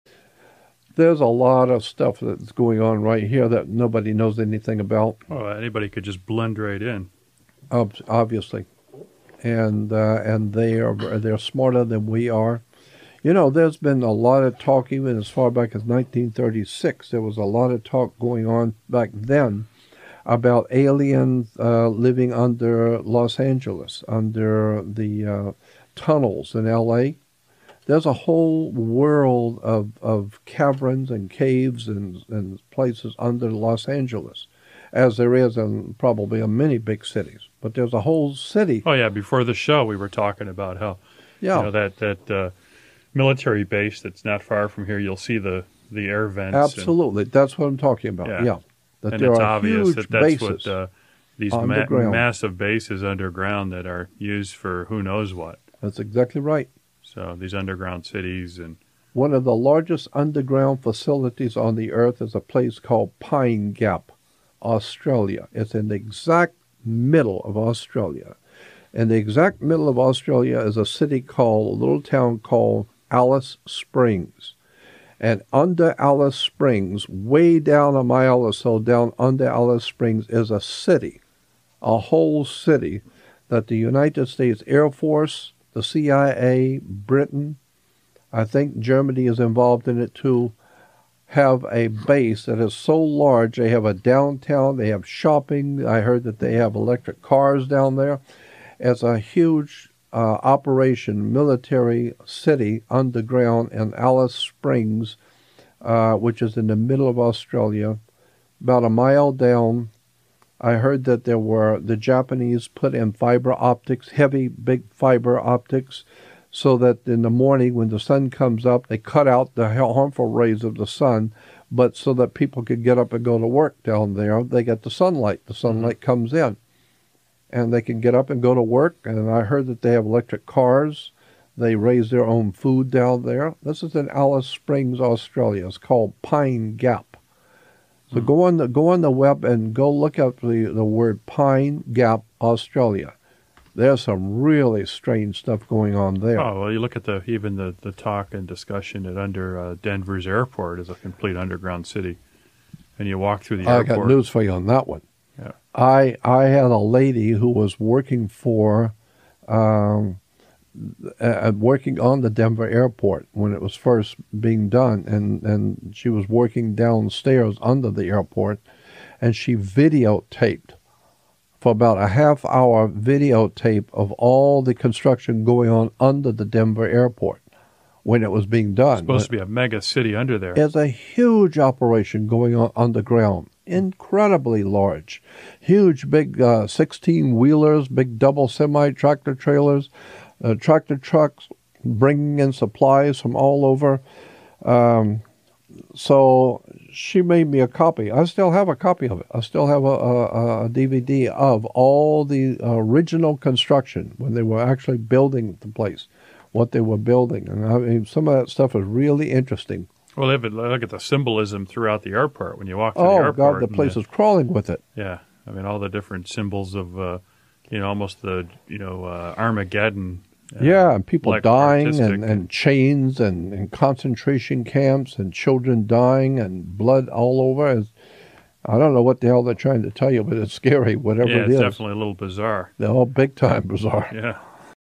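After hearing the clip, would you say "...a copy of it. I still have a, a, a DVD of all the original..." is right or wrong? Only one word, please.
right.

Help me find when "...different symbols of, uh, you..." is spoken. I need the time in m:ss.
3:35.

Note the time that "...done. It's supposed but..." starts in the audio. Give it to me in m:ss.
2:58.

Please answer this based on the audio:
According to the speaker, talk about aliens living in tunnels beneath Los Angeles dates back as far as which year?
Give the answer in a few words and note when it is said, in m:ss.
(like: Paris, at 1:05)
1936, at 0:15.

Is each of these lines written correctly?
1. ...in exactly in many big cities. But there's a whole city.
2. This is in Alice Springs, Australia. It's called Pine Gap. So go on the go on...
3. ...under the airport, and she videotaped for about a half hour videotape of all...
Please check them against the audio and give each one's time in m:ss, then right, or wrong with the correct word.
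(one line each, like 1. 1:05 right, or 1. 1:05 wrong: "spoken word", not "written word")
1. 0:35 wrong: "probably", not "exactly"
2. 2:13 right
3. 2:47 right.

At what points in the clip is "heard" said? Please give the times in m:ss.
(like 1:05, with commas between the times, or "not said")
1:36, 1:50, 2:09.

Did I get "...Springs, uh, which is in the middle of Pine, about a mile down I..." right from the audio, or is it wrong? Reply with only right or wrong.
wrong.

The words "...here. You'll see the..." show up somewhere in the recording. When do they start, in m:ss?
0:44.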